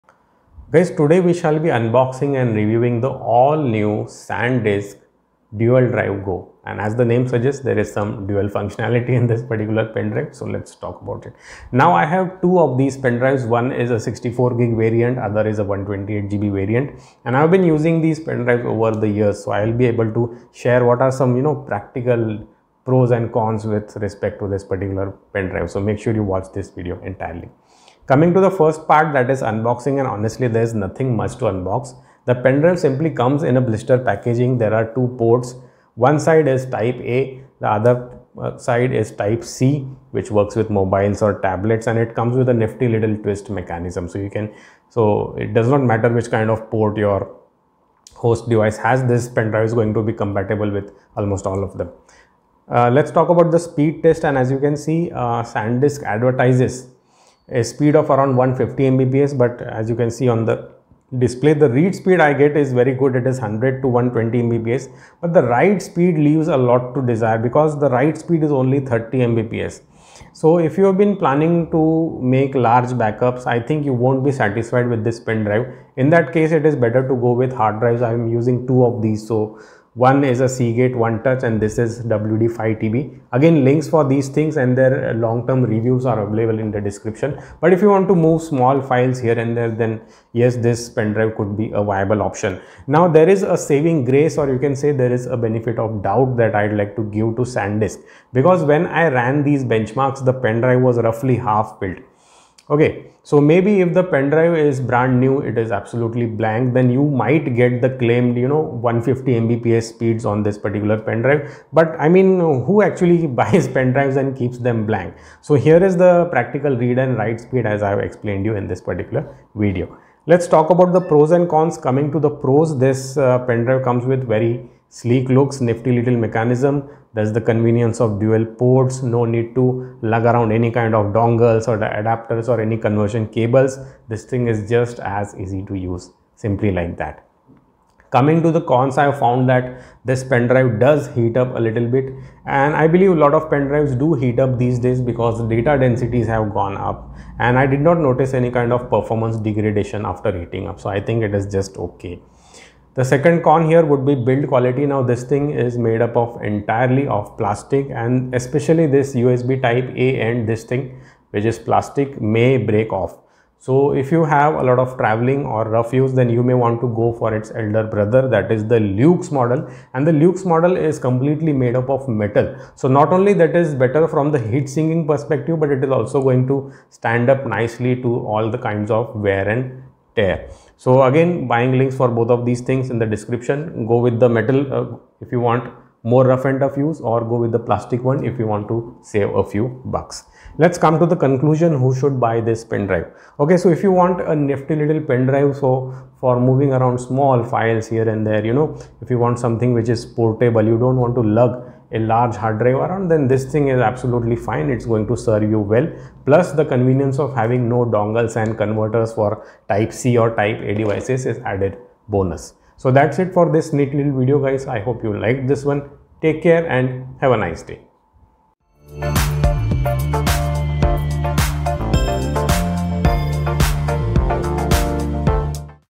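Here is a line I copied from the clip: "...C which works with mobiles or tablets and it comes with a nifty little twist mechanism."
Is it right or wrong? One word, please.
right.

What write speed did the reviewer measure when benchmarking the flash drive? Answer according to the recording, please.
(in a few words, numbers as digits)
30 mbps.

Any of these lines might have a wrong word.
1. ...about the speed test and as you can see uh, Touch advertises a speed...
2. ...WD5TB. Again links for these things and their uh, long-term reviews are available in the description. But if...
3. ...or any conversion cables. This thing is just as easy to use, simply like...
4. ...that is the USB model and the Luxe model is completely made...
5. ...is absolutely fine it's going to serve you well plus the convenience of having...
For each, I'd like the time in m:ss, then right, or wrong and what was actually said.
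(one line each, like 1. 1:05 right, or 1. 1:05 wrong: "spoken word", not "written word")
1. 0:53 wrong: "SanDisk", not "Touch"
2. 1:22 right
3. 2:12 right
4. 2:48 wrong: "Luxe", not "USB"
5. 3:23 right.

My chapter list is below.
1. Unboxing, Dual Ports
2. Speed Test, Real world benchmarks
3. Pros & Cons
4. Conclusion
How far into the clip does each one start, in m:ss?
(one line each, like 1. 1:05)
1. 0:27
2. 0:52
3. 2:00
4. 3:10.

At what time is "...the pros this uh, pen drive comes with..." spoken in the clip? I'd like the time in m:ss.
2:02.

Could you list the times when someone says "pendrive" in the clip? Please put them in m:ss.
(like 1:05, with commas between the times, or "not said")
0:32, 0:49.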